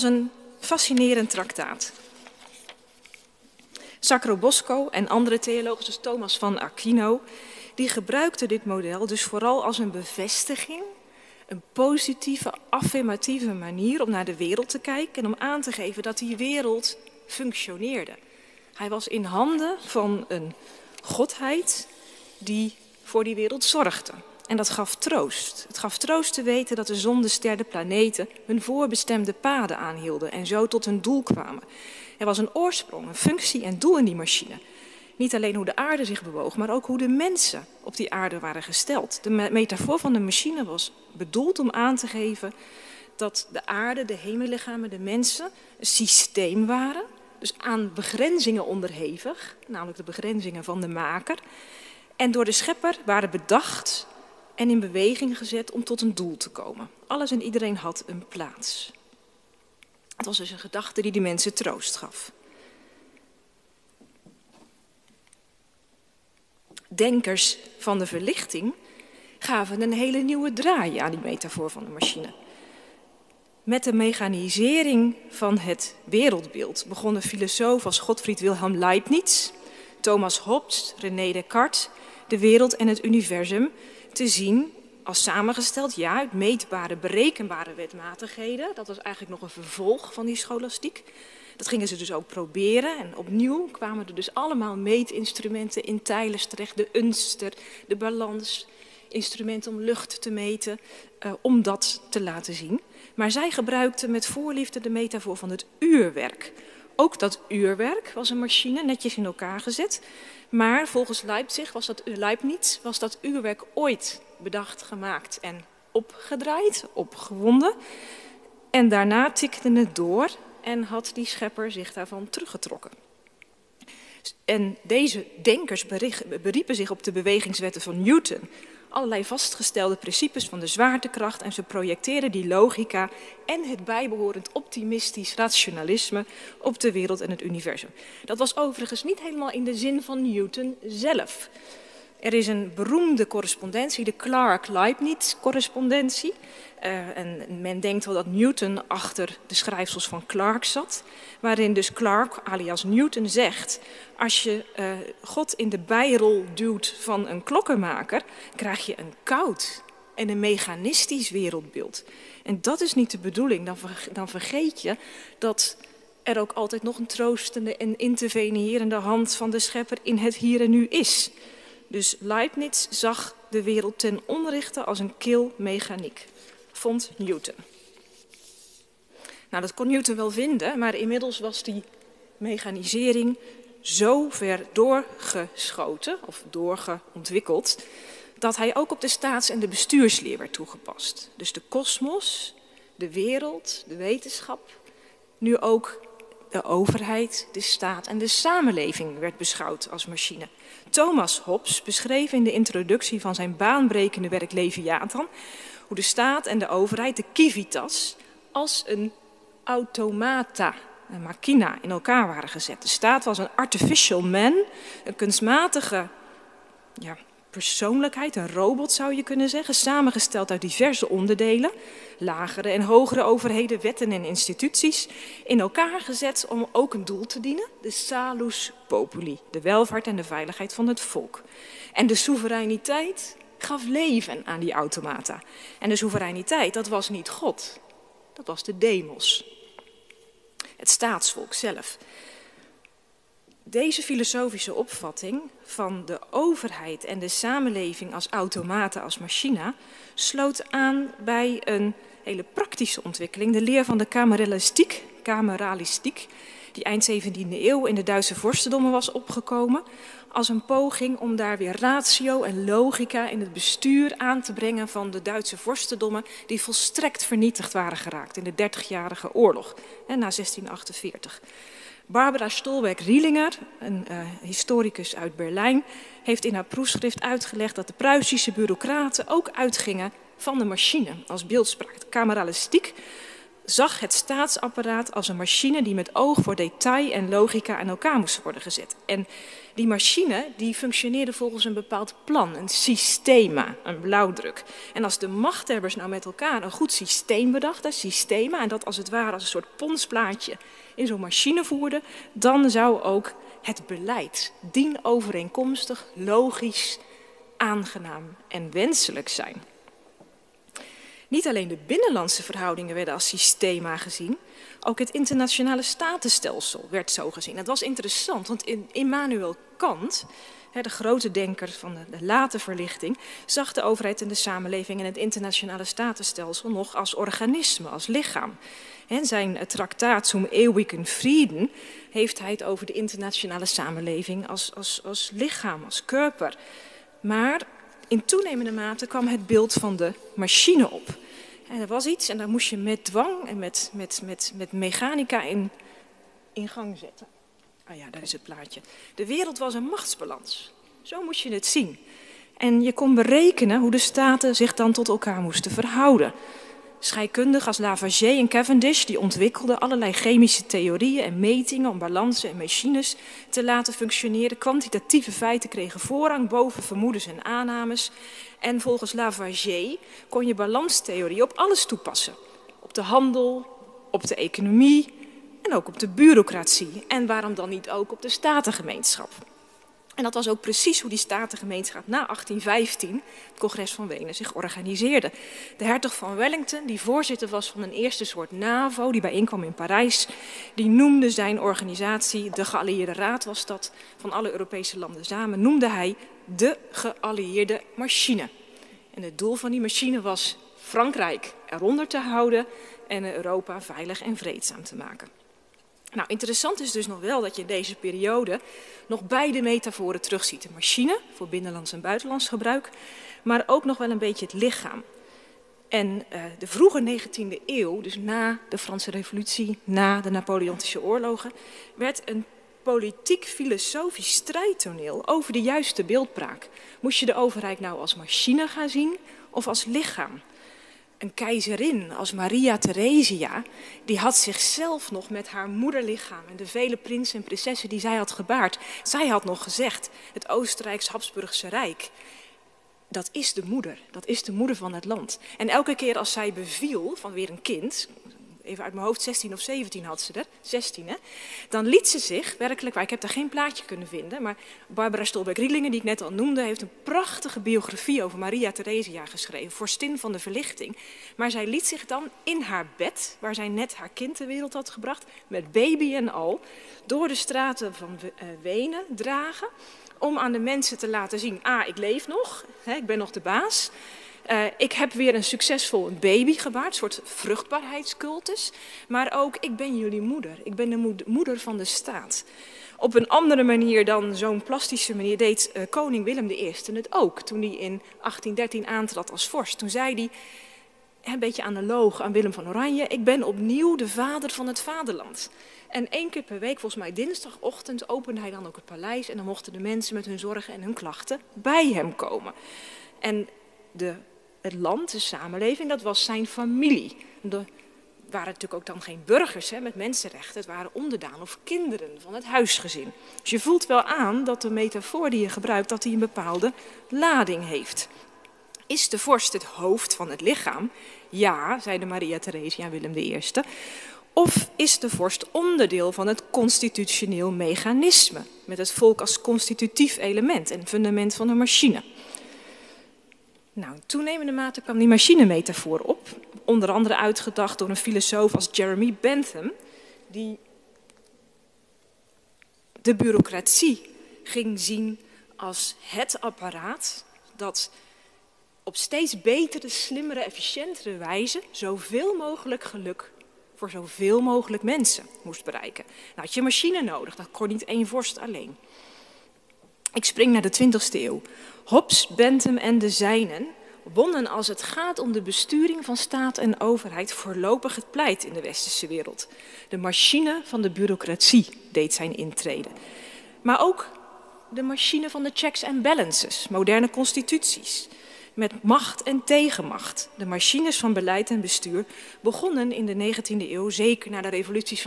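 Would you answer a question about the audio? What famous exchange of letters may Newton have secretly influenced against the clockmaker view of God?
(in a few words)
Clark-Leibniz-correspondentie.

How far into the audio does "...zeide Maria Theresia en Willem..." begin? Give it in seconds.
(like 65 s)
521 s.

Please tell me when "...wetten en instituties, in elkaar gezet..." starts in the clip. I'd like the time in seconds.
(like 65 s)
223 s.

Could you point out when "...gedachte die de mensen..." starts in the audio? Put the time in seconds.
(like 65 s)
60 s.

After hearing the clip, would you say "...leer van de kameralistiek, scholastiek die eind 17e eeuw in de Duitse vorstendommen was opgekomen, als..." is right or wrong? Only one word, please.
wrong.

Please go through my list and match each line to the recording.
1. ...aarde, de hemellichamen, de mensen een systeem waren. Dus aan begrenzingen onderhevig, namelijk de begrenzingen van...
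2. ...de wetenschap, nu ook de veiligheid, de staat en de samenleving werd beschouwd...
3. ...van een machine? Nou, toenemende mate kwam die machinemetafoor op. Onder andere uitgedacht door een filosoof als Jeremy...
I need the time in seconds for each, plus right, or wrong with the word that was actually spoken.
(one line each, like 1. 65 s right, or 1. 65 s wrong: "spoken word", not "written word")
1. 43 s right
2. 193 s wrong: "overheid", not "veiligheid"
3. 531 s right.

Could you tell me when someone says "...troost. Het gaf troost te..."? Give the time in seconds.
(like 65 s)
24 s.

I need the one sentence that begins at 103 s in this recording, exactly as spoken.
Maar zij gebruikten met voorliefde de metafoor van het uurwerk ook dat uurwerk was een machine, netjes in elkaar gezet.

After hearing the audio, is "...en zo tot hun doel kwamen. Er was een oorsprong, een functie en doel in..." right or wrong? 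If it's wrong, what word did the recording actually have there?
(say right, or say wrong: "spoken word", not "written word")
right.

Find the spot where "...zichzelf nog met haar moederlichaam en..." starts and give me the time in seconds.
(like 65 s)
434 s.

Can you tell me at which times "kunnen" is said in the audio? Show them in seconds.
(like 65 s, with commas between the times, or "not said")
219 s, 453 s.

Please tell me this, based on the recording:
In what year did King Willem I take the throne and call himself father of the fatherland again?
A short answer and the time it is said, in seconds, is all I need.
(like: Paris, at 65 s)
1813, at 488 s.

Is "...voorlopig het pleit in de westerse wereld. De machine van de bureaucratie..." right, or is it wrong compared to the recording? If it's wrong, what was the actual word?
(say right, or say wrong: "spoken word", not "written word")
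right.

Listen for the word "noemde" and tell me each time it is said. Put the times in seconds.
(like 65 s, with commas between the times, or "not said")
390 s, 395 s, 456 s.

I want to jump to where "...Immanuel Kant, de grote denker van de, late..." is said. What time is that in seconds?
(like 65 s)
318 s.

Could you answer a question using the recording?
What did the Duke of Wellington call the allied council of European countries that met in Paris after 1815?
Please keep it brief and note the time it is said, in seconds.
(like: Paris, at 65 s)
Geallieerde Machine, at 396 s.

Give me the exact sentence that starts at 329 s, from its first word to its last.
In zijn traktaat Zum Ewigen vrede' heeft hij het over de internationale samenleving als, als, als lichaam, als körper.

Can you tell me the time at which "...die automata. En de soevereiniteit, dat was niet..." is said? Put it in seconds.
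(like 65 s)
234 s.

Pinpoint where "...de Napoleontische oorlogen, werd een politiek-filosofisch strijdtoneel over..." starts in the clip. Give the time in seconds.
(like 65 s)
420 s.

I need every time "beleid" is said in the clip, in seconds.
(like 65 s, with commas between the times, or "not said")
303 s, 581 s.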